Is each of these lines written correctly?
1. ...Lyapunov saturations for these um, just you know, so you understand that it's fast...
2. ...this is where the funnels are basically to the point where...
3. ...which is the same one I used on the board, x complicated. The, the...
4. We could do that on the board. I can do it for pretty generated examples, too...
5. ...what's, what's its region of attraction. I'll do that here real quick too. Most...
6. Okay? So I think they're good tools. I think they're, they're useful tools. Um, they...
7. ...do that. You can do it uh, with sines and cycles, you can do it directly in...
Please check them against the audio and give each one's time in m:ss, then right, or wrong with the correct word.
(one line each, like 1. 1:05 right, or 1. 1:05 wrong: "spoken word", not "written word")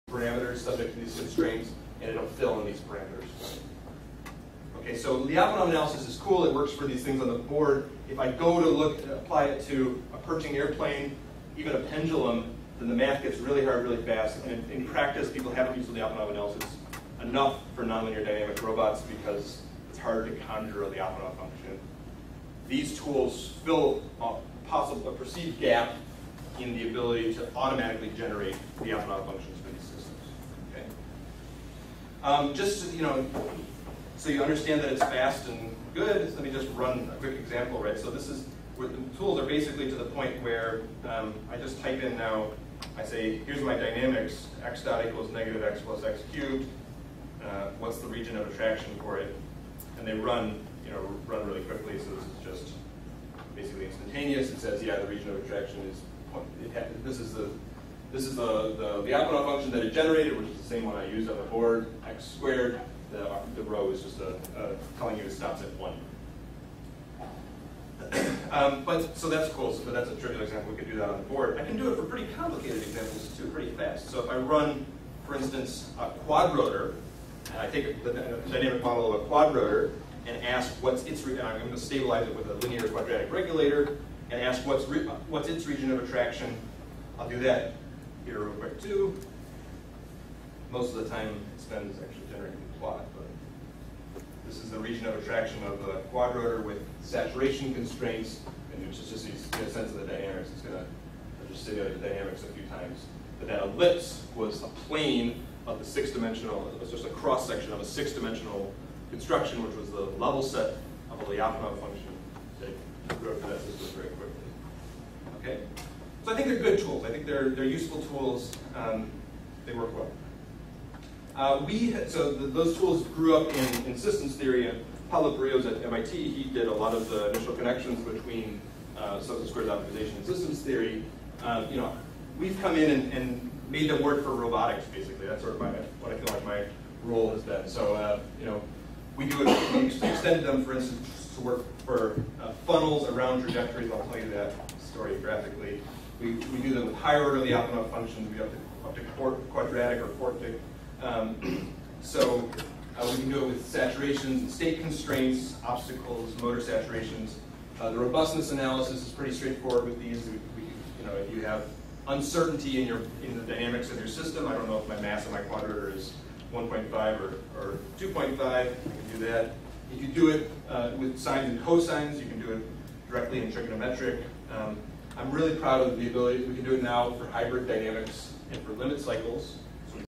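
1. 0:28 wrong: "functions", not "saturations"
2. 0:38 wrong: "tools", not "funnels"
3. 1:00 wrong: "squared", not "complicated"
4. 1:10 wrong: "complicated", not "generated"
5. 1:24 right
6. 1:55 right
7. 2:49 wrong: "cosines", not "cycles".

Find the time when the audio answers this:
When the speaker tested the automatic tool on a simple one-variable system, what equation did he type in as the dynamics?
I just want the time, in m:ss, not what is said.
0:44.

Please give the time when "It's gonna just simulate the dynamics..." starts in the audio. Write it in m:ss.
1:40.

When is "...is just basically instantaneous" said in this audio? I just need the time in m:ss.
0:52.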